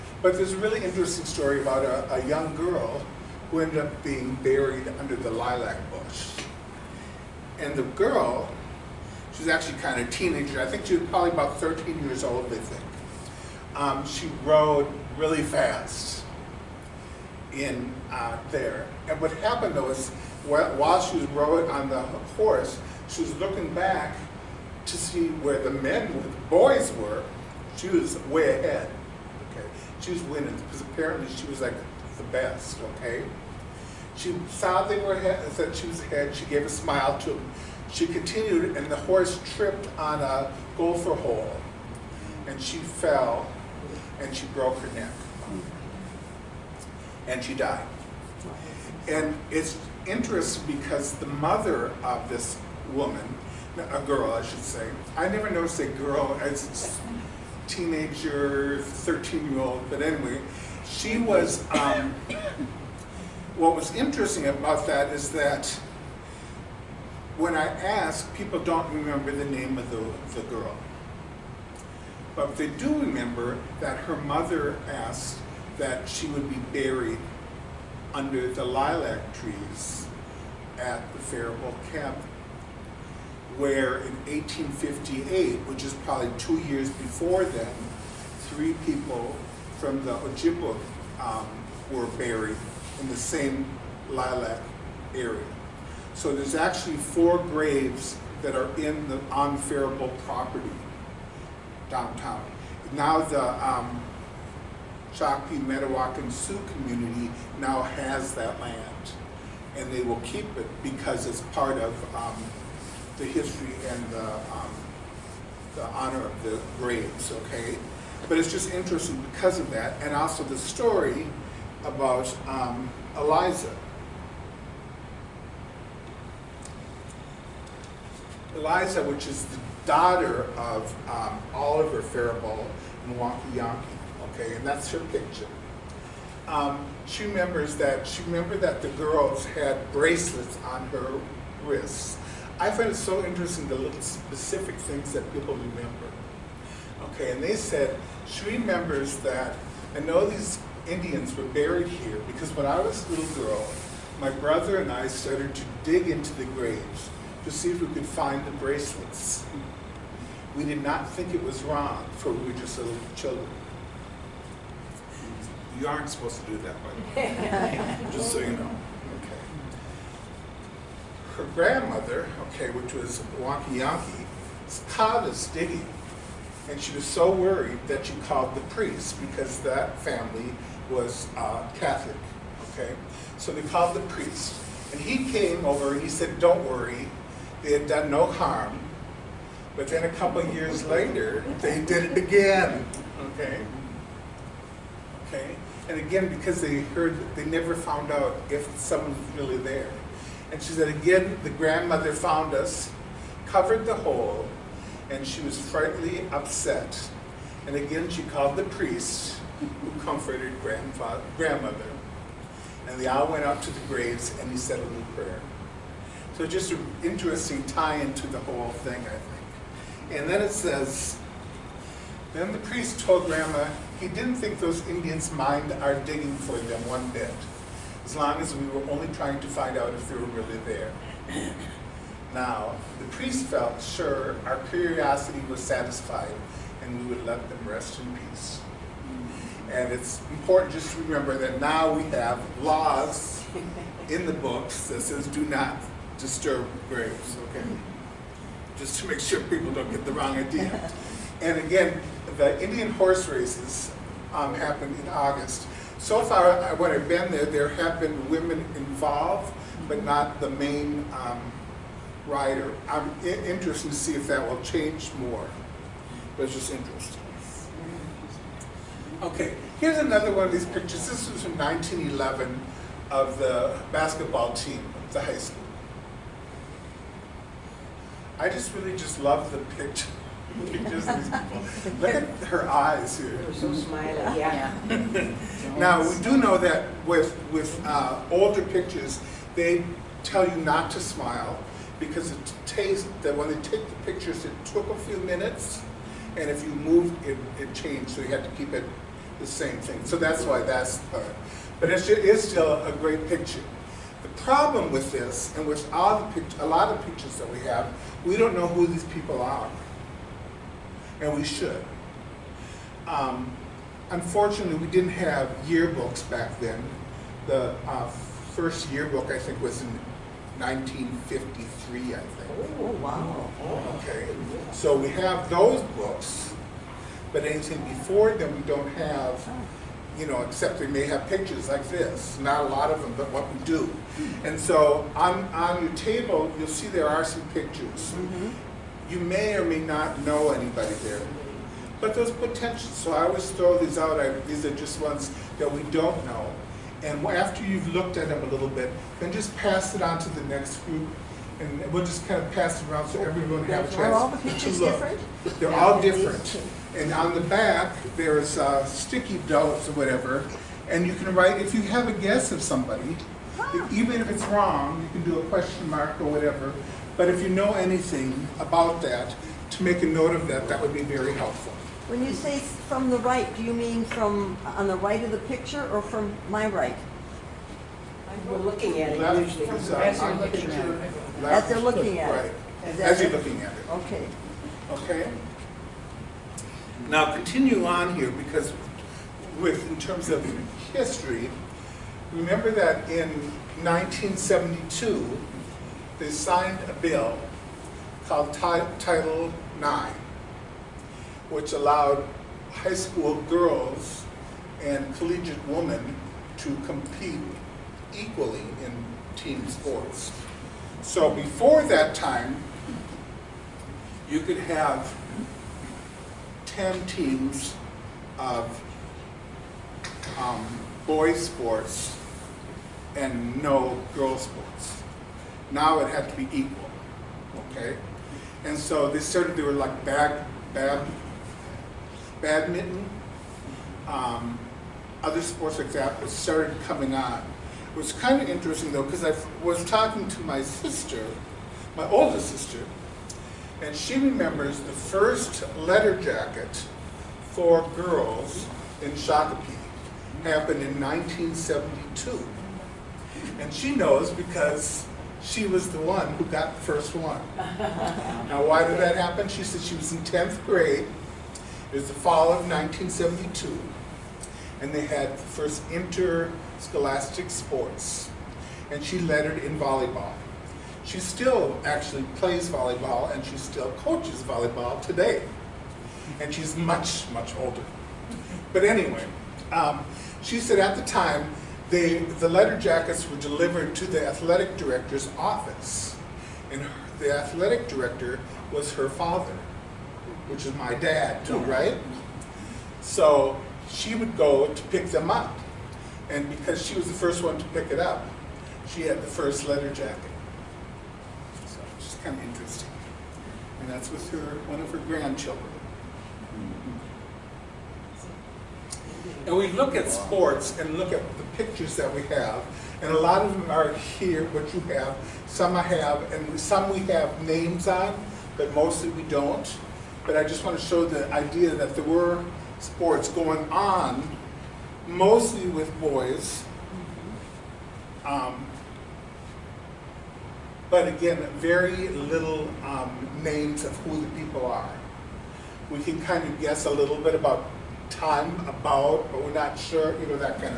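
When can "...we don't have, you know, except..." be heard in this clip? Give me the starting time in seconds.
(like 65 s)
328 s.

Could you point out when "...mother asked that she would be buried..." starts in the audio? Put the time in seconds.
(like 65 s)
74 s.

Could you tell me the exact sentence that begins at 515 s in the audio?
Some I have, and some we have names on, but mostly we don't.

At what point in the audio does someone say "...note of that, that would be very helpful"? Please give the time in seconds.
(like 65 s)
370 s.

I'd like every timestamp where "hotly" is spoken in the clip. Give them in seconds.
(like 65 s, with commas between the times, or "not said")
not said.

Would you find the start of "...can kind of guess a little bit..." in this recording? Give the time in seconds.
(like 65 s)
535 s.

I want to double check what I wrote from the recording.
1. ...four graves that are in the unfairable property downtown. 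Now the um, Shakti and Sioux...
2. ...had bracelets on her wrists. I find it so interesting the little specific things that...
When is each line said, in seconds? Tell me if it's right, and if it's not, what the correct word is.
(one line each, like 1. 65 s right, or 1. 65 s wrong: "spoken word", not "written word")
1. 96 s right
2. 139 s right.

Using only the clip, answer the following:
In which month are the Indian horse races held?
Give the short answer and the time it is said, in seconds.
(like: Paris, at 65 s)
August, at 255 s.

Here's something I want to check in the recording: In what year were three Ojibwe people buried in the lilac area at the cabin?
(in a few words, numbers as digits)
1858.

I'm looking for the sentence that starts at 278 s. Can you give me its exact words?
I just really just love the picture.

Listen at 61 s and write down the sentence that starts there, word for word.
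Um, what was interesting about that is that when I ask, people don't remember the name of the, the girl.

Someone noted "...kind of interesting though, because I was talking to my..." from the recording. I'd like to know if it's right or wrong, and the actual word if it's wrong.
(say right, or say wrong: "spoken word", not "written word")
right.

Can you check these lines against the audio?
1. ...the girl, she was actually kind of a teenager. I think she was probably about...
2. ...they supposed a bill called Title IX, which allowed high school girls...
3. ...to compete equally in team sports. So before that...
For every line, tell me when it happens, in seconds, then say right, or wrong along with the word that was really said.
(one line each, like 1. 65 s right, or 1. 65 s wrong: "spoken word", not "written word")
1. 7 s right
2. 396 s wrong: "signed", not "supposed"
3. 406 s right.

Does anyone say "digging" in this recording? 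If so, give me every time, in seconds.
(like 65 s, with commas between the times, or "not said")
175 s, 225 s.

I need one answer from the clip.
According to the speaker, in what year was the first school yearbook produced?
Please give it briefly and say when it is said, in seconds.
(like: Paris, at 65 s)
1953, at 320 s.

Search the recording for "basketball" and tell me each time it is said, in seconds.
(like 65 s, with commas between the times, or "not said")
273 s.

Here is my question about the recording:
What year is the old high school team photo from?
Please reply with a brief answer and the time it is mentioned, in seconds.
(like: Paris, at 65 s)
1911, at 271 s.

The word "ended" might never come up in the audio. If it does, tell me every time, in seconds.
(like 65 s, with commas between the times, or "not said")
3 s.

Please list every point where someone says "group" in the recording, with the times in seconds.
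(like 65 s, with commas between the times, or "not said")
350 s.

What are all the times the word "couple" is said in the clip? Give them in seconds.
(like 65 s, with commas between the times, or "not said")
190 s.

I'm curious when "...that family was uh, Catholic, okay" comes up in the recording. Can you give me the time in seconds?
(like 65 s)
179 s.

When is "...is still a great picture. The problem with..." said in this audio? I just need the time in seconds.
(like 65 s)
302 s.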